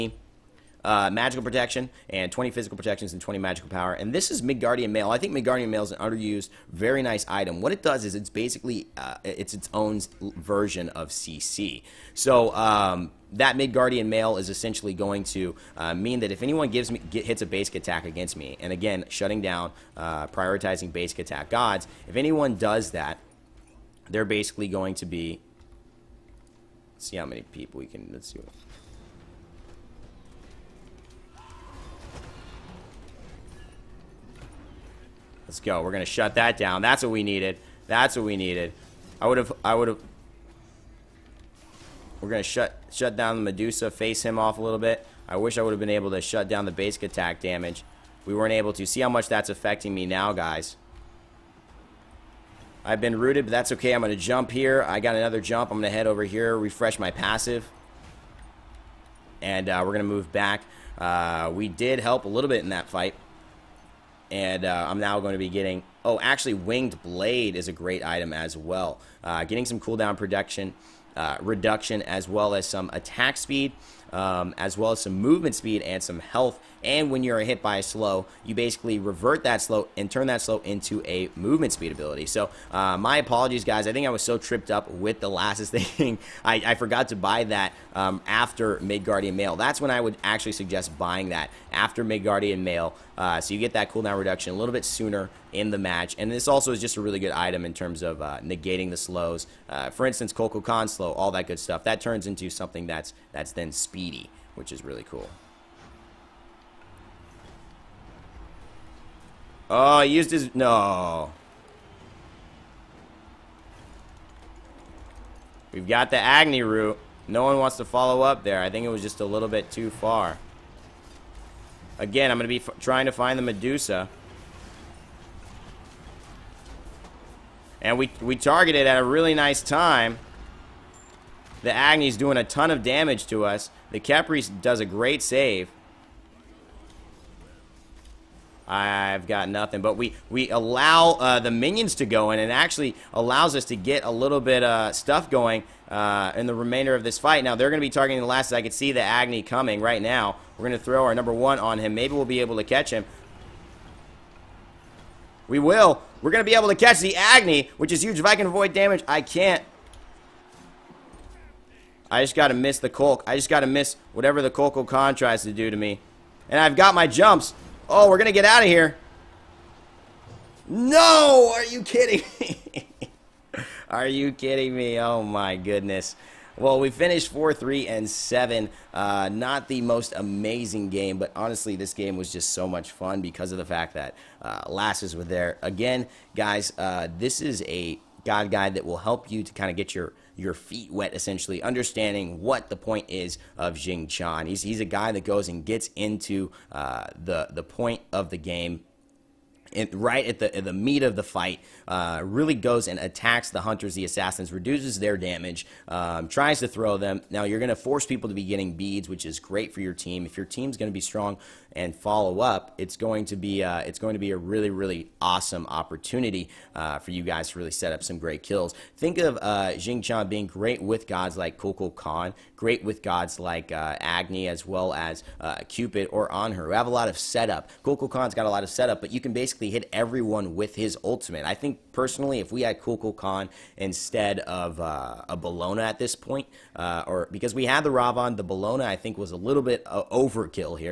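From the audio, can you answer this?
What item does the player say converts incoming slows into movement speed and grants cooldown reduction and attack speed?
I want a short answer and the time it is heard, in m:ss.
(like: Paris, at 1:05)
Winged Blade, at 1:06.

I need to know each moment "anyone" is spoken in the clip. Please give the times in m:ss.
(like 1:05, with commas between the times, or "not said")
0:16, 0:22.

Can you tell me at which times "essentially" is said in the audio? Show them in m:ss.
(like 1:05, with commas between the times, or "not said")
0:14, 3:11.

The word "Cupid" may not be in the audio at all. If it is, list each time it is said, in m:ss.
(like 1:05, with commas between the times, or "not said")
3:45.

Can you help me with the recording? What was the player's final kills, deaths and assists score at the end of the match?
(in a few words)
4 3 and 7.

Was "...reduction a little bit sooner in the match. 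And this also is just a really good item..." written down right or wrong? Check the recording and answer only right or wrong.
right.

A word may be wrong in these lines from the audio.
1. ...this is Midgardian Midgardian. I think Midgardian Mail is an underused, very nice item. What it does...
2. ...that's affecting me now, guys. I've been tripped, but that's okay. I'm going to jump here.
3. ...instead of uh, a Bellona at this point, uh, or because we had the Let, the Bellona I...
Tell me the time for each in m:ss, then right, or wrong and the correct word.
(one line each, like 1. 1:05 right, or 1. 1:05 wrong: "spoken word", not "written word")
1. 0:04 wrong: "Mail", not "Midgardian"
2. 0:49 wrong: "rooted", not "tripped"
3. 3:53 wrong: "Ravon", not "Let".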